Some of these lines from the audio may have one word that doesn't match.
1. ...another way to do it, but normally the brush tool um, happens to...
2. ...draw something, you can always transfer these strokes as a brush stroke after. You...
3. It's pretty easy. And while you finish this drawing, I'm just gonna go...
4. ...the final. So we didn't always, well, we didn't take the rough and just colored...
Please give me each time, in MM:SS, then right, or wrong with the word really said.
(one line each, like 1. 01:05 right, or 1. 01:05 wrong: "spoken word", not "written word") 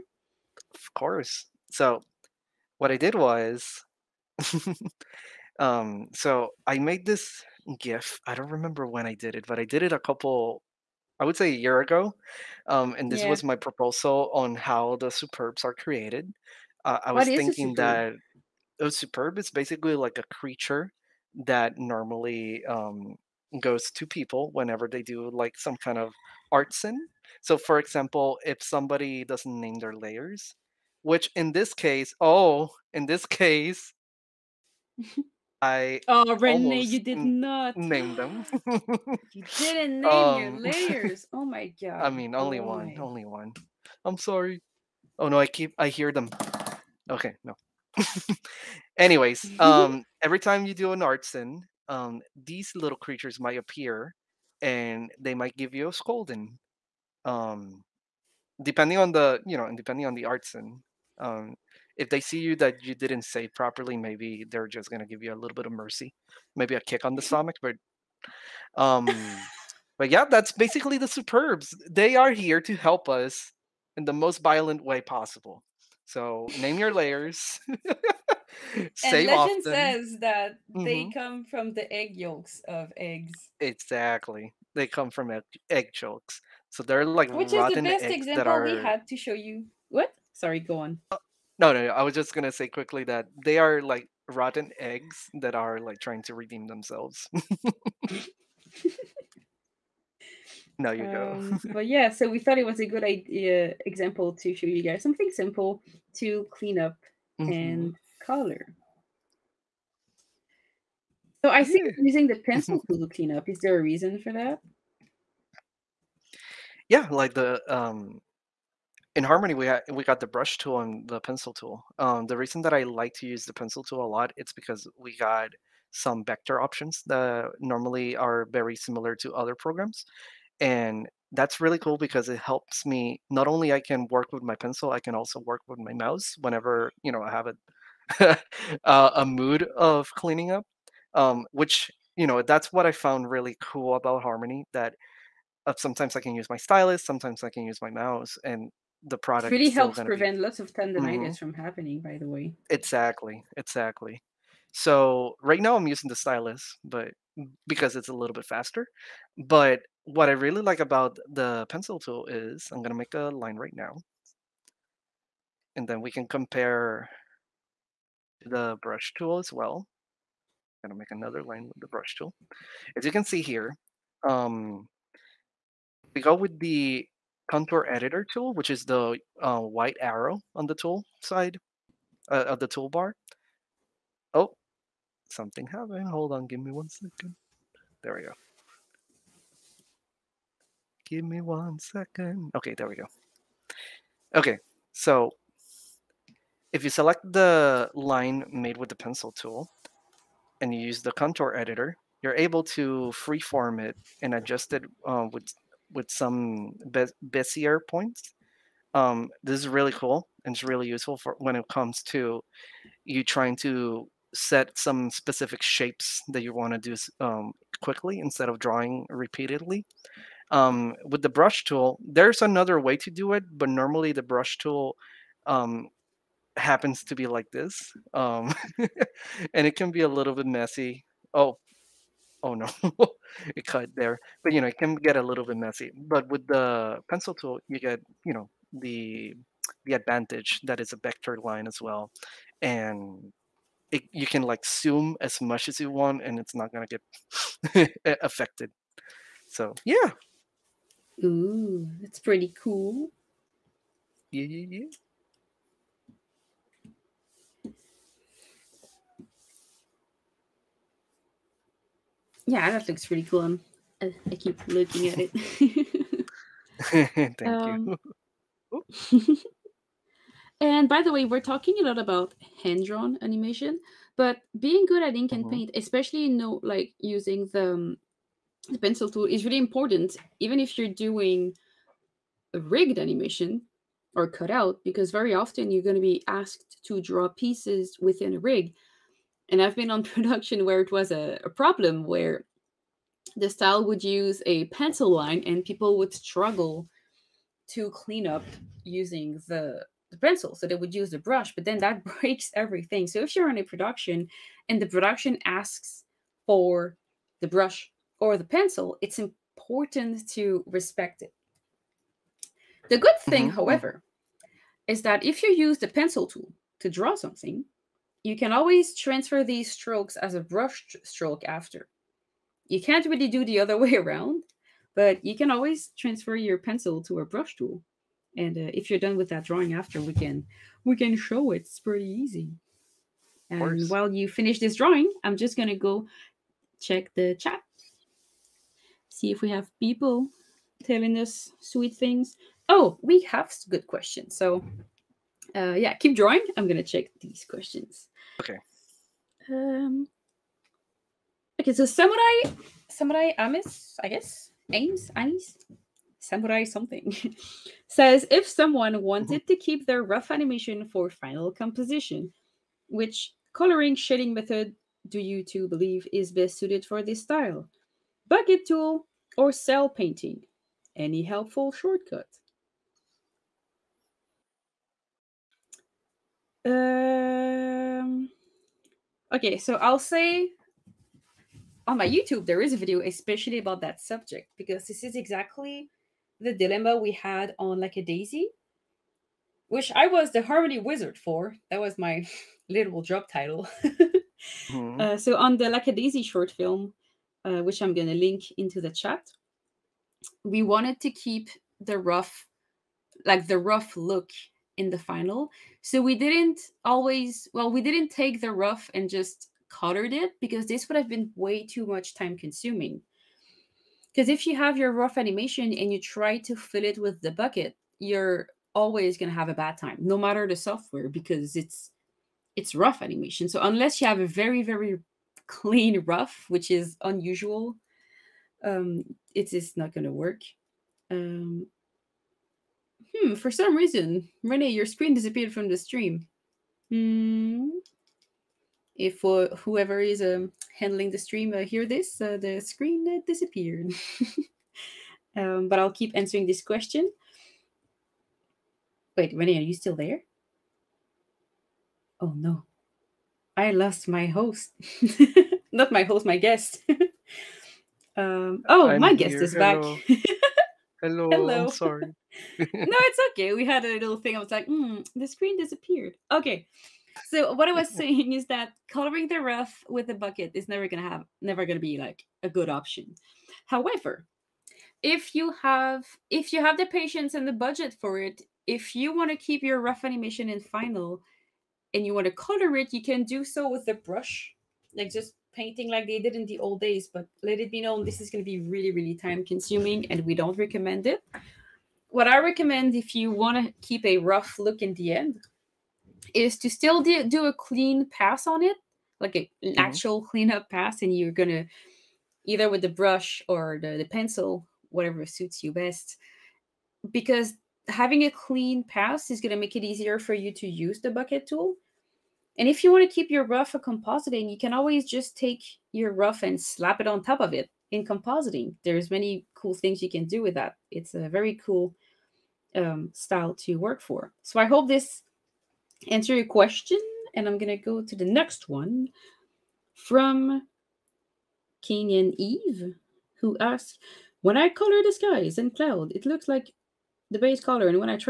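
1. 03:42 right
2. 05:16 right
3. 05:31 right
4. 06:44 right.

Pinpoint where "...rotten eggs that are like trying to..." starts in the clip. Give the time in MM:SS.
01:34.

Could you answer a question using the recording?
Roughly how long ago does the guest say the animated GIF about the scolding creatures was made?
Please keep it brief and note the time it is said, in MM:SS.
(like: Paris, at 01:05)
A year ago, at 00:11.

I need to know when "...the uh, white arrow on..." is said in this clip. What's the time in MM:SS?
02:58.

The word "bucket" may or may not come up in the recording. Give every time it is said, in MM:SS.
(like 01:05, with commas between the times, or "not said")
06:08, 06:57, 07:50, 08:31.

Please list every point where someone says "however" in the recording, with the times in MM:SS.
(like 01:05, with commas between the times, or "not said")
05:13, 07:53.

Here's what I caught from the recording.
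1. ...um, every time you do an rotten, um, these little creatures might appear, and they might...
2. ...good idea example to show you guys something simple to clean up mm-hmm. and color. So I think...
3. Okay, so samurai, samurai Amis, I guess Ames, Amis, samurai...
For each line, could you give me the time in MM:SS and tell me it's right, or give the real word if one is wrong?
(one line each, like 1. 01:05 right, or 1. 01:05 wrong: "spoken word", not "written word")
1. 00:49 wrong: "artsen", not "rotten"
2. 01:42 right
3. 05:51 right.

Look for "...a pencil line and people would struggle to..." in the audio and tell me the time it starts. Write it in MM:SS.
04:54.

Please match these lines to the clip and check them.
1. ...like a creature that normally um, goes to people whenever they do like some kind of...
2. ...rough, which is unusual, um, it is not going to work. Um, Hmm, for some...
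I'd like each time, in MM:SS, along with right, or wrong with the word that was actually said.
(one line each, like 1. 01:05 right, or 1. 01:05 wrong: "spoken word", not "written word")
1. 00:19 right
2. 07:06 right.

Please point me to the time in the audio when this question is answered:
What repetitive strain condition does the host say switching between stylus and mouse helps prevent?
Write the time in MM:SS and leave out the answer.
02:30.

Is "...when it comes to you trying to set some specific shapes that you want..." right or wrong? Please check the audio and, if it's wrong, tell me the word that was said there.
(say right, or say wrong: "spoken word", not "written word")
right.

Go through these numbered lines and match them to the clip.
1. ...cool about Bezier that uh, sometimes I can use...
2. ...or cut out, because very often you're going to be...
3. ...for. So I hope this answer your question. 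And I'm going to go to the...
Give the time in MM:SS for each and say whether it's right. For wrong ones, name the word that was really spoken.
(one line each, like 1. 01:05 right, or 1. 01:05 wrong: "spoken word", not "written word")
1. 02:23 wrong: "Harmony", not "Bezier"
2. 04:44 right
3. 08:44 right.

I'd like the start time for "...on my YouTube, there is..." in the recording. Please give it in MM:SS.
06:21.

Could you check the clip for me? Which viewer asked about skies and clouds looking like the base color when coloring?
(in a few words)
Kenyan Eve.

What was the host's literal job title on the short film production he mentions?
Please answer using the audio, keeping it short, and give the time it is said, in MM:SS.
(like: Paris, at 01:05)
Harmony Wizard, at 06:30.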